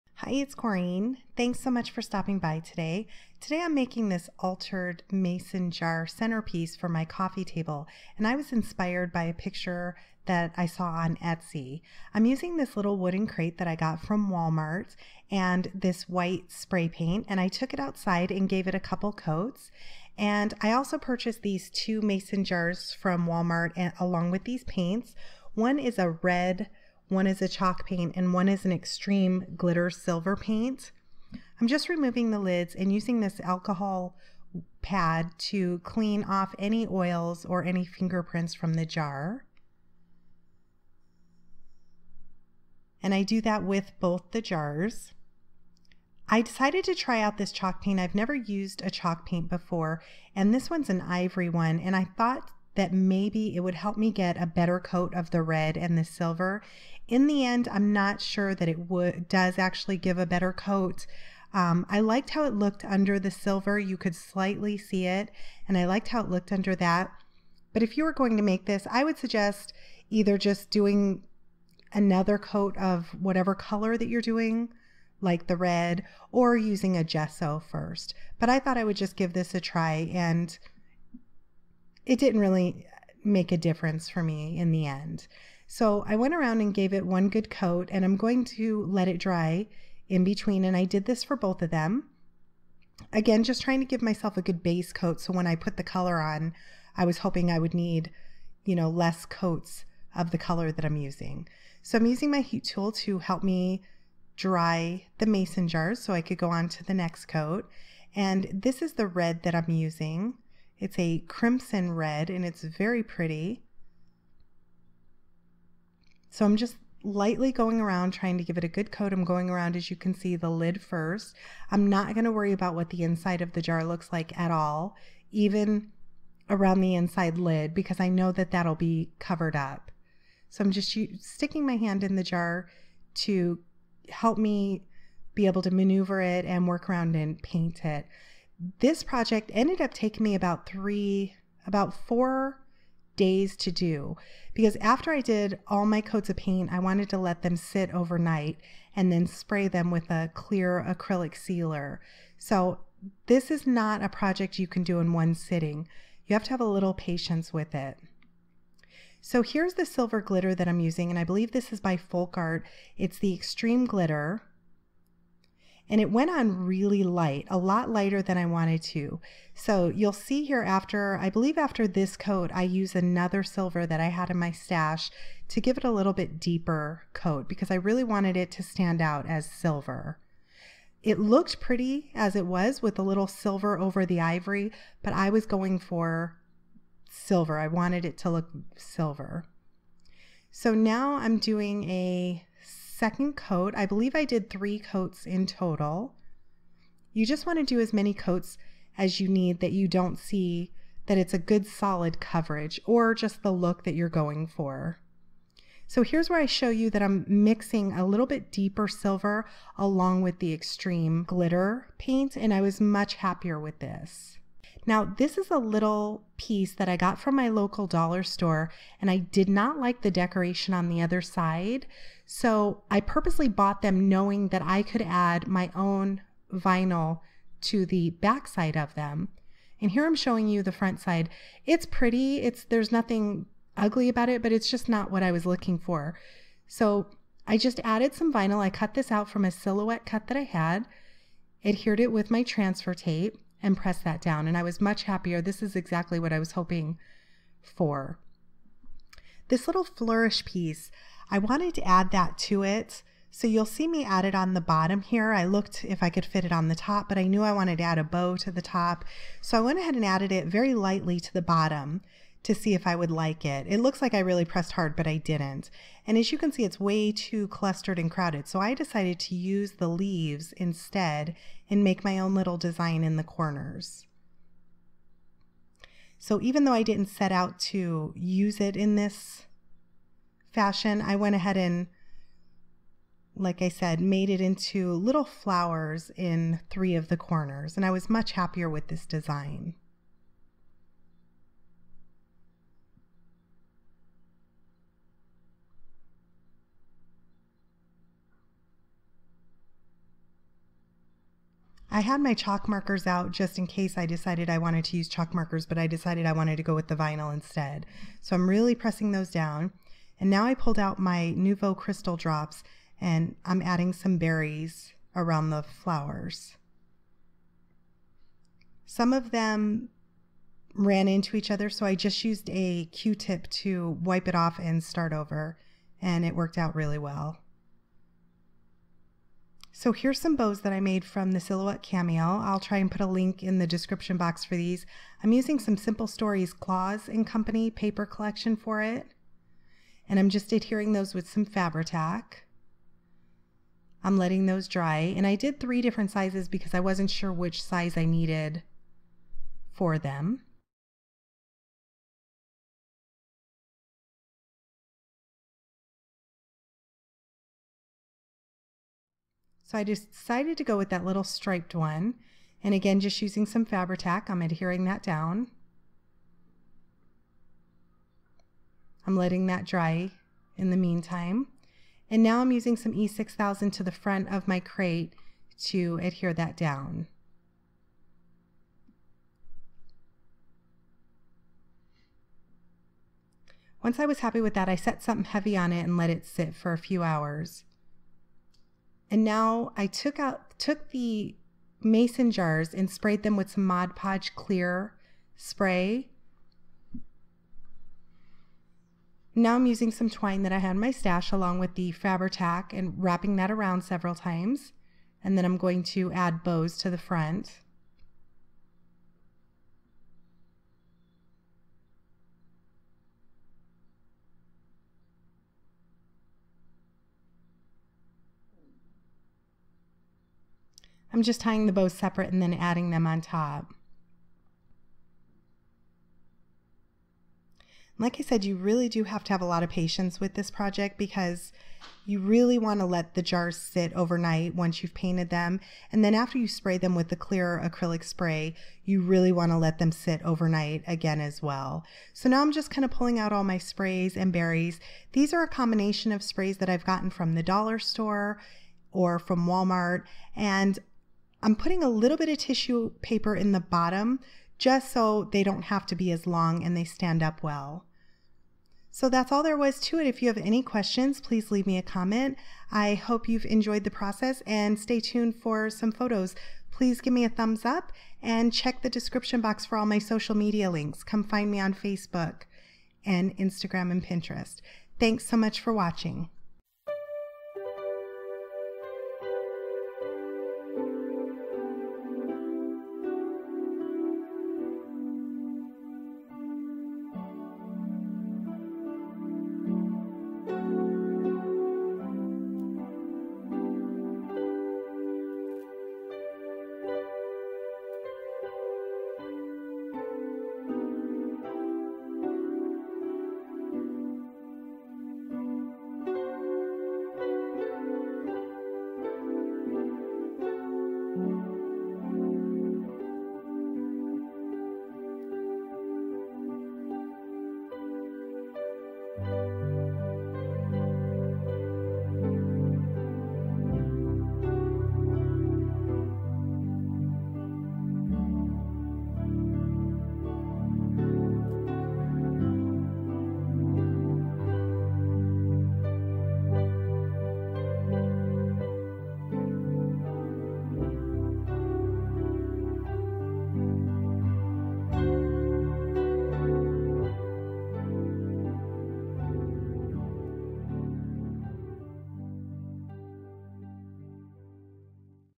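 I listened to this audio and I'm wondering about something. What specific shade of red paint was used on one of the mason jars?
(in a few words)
Crimson red.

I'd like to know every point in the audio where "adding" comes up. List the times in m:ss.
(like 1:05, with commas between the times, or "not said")
5:13, 7:02.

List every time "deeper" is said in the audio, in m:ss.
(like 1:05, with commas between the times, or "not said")
2:56, 3:28.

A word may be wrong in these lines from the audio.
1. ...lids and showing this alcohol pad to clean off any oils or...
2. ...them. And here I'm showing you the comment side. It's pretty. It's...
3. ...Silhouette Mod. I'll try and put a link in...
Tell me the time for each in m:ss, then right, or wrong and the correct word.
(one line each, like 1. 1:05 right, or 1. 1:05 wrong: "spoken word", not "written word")
1. 0:32 wrong: "using", not "showing"
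2. 3:48 wrong: "front", not "comment"
3. 5:31 wrong: "Cameo", not "Mod".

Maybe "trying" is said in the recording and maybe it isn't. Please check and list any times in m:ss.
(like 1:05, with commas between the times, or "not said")
1:33, 1:58.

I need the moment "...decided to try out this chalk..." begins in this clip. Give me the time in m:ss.
0:46.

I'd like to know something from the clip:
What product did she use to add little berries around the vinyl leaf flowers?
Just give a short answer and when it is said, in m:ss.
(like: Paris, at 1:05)
Nuvo Crystal Drops, at 5:11.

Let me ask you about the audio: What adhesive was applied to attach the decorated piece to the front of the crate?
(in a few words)
E6000.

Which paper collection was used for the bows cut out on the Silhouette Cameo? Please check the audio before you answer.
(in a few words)
Claus and Company.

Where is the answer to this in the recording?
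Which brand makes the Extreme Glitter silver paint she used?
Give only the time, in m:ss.
2:41.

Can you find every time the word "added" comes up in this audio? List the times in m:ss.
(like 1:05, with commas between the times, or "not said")
3:57, 4:20.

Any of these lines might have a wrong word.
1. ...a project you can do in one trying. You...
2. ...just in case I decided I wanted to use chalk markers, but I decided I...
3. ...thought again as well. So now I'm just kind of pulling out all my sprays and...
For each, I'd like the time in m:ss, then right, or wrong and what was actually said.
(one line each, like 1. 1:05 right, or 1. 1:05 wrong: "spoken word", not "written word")
1. 2:34 wrong: "sitting", not "trying"
2. 5:03 right
3. 7:20 wrong: "overnight", not "thought".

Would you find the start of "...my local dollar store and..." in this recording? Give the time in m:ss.
3:37.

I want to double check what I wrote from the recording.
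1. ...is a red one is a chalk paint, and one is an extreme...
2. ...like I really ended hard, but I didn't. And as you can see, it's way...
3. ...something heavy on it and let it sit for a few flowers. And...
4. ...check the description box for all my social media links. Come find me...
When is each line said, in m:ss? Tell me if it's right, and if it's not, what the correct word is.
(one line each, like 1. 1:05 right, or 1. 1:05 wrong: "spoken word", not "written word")
1. 0:25 right
2. 4:24 wrong: "pressed", not "ended"
3. 6:25 wrong: "hours", not "flowers"
4. 7:48 right.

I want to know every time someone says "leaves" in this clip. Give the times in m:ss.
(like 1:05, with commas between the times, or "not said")
4:29, 7:41.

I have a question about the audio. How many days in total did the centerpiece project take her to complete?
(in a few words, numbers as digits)
4.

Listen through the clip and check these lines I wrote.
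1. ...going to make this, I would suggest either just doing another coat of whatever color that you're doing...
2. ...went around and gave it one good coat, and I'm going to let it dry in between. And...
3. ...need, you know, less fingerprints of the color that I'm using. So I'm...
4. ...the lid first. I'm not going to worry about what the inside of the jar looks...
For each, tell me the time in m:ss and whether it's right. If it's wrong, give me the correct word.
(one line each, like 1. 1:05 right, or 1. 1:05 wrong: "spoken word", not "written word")
1. 1:08 right
2. 1:26 right
3. 1:37 wrong: "coats", not "fingerprints"
4. 2:00 right.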